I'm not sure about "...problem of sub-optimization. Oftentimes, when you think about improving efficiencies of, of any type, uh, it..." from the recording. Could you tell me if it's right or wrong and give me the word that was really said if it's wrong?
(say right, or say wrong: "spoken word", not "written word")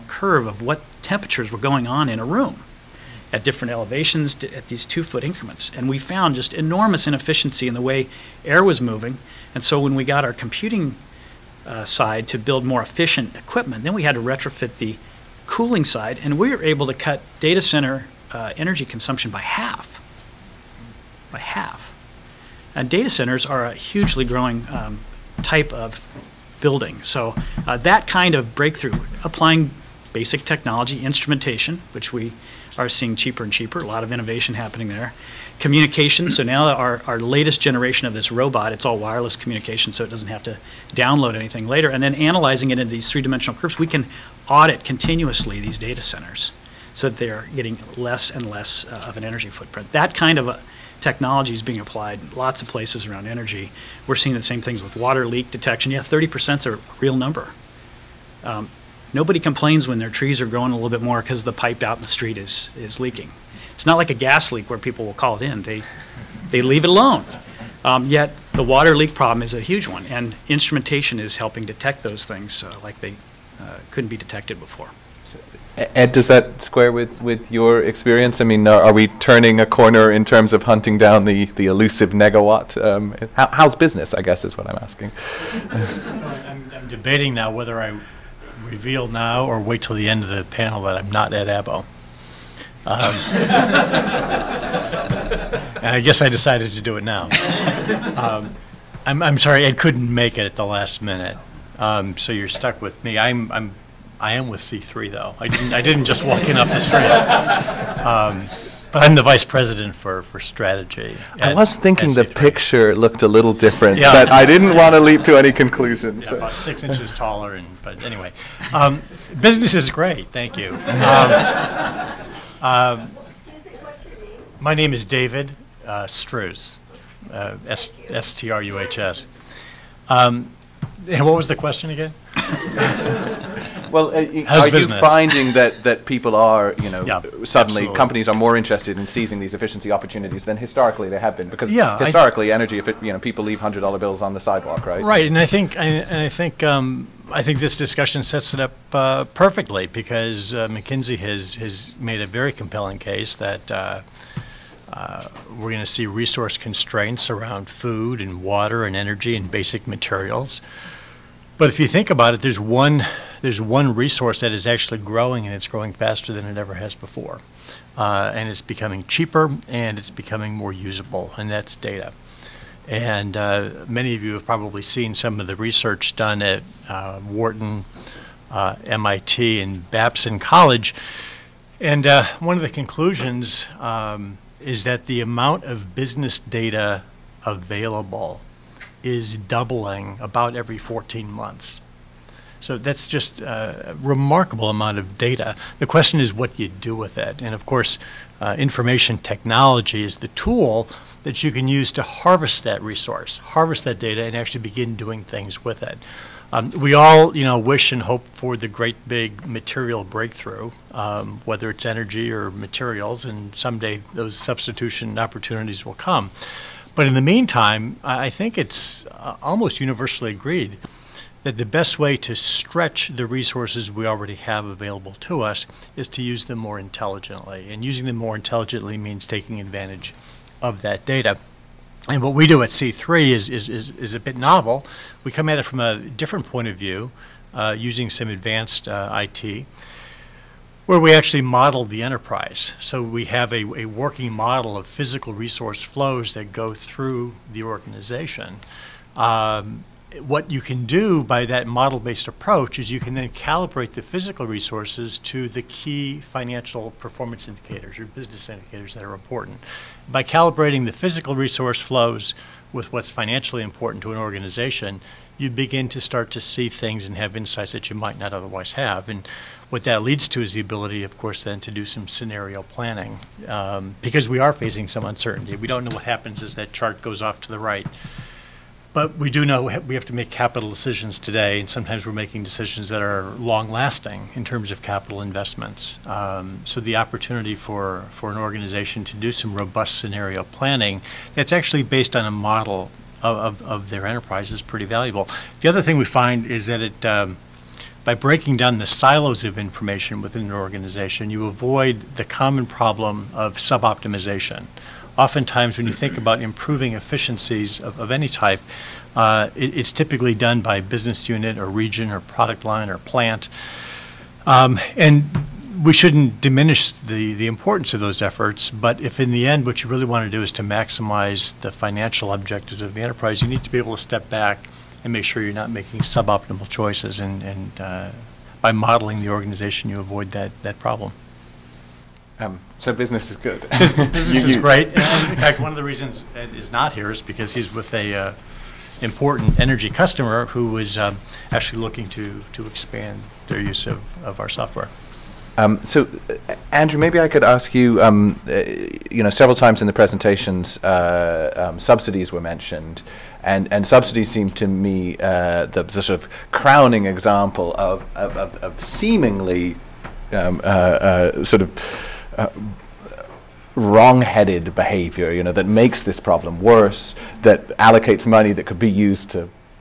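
right.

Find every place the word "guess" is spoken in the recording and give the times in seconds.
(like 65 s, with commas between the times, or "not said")
84 s, 96 s.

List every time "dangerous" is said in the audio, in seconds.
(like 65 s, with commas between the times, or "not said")
not said.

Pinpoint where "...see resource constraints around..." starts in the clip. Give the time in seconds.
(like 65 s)
155 s.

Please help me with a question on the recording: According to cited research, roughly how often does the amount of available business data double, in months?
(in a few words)
14 months.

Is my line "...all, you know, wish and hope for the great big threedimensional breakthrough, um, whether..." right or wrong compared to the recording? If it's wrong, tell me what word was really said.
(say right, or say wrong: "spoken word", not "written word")
wrong: "material", not "threedimensional".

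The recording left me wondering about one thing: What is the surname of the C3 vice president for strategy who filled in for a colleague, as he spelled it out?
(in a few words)
Struhs.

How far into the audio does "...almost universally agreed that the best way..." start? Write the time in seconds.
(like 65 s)
219 s.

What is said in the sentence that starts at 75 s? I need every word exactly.
Ed, does that square with, with your experience?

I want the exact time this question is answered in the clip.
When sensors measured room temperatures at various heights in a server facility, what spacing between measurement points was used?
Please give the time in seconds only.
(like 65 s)
4 s.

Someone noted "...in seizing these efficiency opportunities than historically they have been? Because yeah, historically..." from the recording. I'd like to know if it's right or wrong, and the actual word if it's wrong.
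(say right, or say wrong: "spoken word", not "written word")
right.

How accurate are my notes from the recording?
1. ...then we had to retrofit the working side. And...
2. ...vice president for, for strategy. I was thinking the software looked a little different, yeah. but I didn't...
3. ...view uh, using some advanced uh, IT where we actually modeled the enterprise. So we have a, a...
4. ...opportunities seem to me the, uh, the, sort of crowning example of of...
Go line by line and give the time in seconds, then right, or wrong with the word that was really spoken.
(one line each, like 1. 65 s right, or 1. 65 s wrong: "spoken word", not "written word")
1. 13 s wrong: "cooling", not "working"
2. 109 s wrong: "picture", not "software"
3. 236 s right
4. 353 s wrong: "subsidies", not "opportunities".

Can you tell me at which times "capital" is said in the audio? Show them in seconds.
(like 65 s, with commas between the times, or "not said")
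280 s, 284 s.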